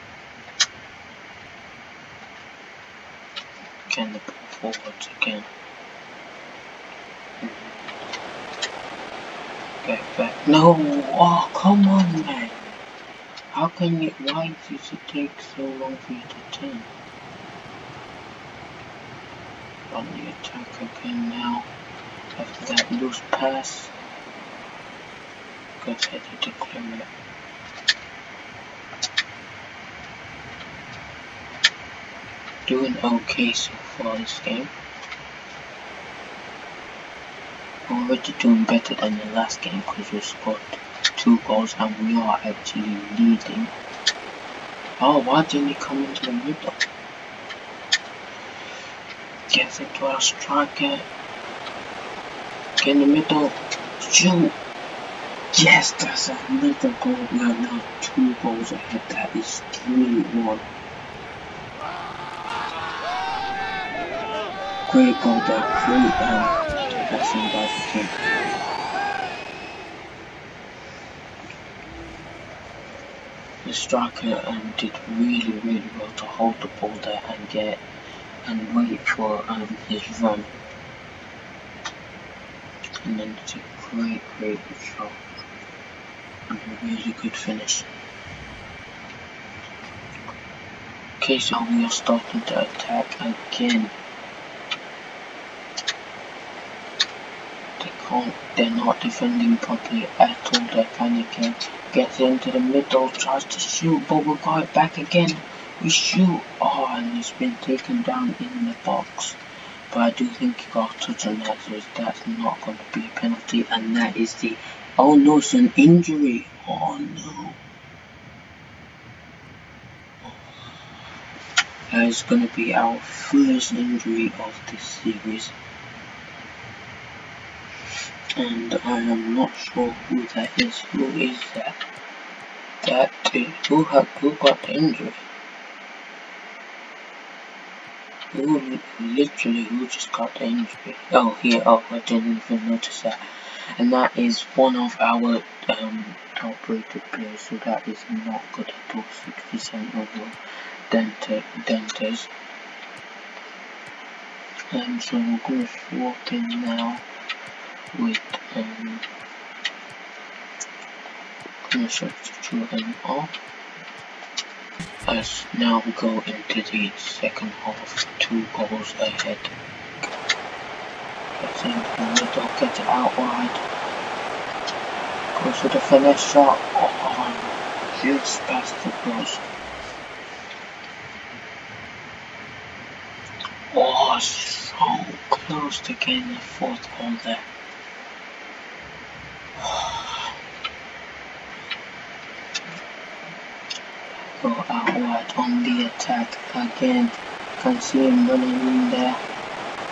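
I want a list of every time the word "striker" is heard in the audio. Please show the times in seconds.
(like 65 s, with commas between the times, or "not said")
50 s, 73 s.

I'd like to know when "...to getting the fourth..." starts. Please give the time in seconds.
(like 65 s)
185 s.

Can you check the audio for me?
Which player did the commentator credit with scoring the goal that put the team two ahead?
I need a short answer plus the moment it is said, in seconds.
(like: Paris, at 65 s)
Crew, at 65 s.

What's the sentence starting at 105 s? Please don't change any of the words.
We shoot, oh, and he's been taken down in the box.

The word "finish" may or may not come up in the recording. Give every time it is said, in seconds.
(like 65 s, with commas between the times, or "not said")
87 s, 175 s.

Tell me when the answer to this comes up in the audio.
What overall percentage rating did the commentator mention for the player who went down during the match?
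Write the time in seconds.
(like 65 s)
149 s.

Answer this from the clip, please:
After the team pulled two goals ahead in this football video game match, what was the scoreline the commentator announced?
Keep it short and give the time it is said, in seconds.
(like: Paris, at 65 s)
3-1, at 59 s.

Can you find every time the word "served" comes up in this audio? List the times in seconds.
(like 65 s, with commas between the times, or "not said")
not said.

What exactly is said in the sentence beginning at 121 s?
That is going to be our first injury of this series and I am not sure who that is.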